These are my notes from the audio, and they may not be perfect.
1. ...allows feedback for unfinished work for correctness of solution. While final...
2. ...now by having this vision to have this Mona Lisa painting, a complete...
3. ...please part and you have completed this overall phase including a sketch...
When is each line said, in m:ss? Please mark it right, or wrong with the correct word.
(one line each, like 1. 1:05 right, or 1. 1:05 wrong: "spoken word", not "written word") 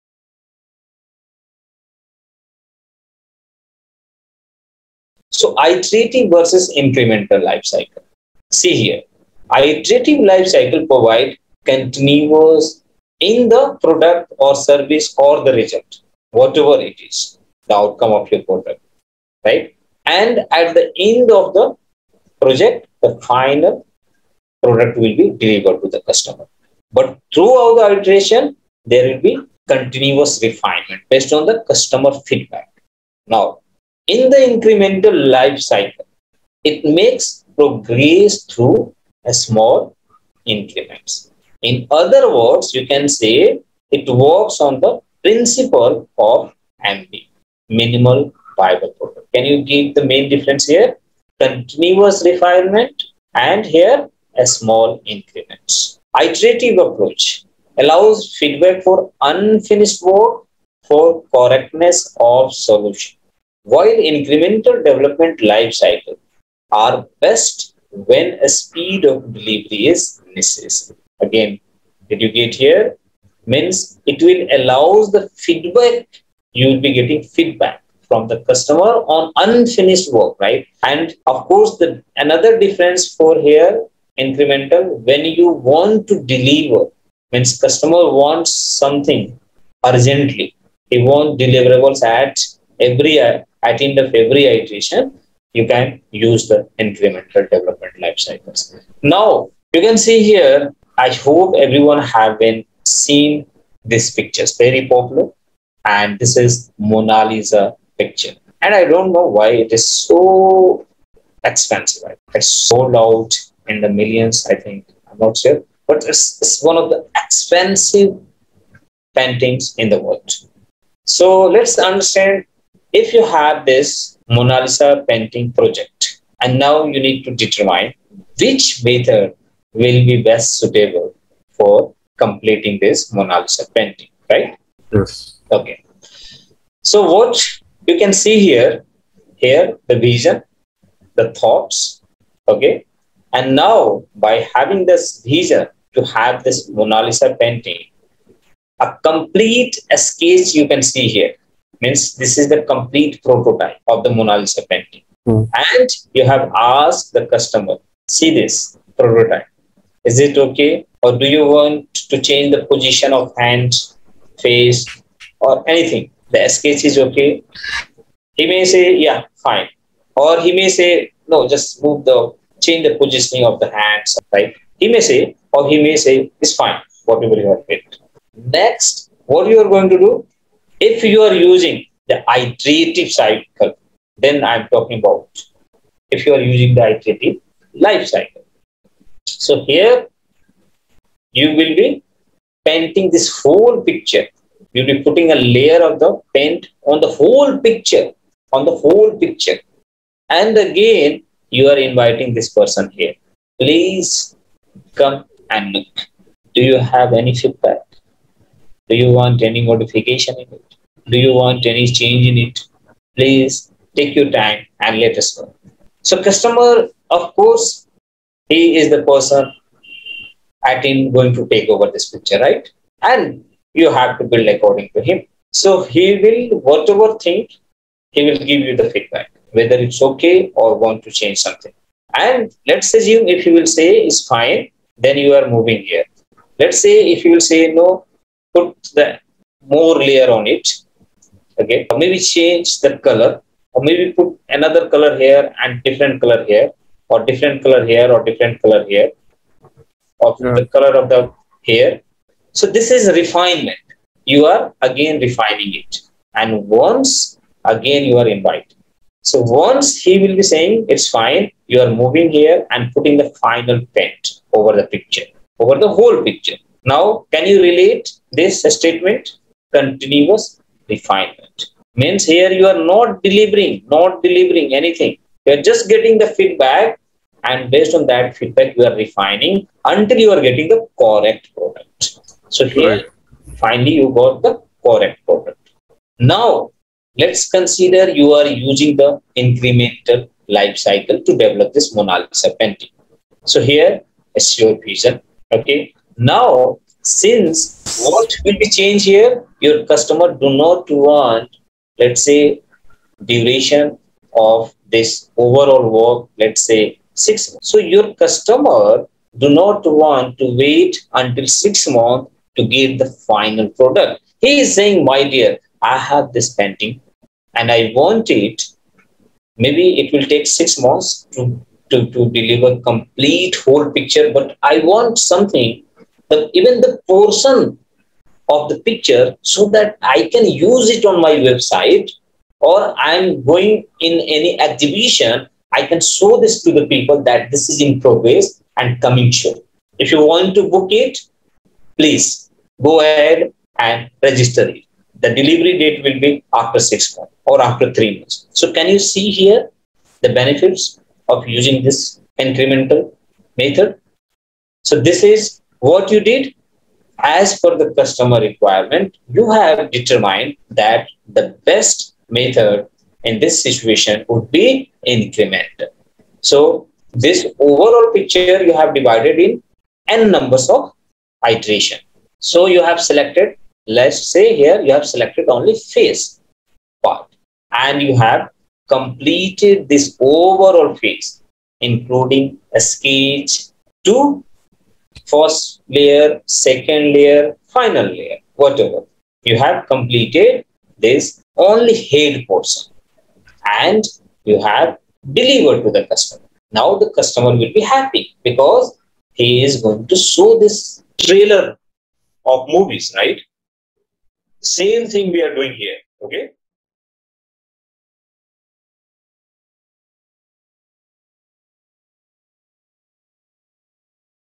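1. 0:57 wrong: "incremental", not "final"
2. 2:23 right
3. 6:15 wrong: "phase", not "please".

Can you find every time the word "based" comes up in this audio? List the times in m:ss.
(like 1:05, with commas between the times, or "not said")
0:31, 4:37.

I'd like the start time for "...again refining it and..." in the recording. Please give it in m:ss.
4:14.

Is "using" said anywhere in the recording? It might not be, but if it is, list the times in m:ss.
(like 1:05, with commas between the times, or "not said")
3:01, 3:06, 4:48, 5:51.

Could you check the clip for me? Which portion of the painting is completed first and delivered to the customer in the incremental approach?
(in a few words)
Head.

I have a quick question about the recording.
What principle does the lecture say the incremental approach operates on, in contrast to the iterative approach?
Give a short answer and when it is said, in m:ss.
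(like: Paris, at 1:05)
Minimal viable product, at 0:47.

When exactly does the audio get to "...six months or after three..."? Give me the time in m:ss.
5:46.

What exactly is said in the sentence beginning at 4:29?
Continuous refinement means here you are not delivering, not delivering anything.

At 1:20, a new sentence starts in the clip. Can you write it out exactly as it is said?
And of course, the another difference for here, incremental, when you want to deliver, means customer wants something urgently.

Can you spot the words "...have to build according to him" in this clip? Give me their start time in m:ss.
3:43.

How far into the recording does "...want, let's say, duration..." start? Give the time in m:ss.
5:00.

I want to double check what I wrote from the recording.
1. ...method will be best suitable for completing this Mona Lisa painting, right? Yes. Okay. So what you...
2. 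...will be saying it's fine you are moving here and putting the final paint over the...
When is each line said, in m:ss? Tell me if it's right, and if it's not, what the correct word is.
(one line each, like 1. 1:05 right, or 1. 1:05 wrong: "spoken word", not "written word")
1. 2:08 right
2. 4:20 right.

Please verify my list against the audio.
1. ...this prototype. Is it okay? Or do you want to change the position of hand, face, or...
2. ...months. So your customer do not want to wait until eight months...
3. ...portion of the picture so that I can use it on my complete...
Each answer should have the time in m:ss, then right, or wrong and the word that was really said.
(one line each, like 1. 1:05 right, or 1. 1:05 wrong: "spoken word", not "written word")
1. 2:38 right
2. 5:07 wrong: "six", not "eight"
3. 5:27 wrong: "website", not "complete".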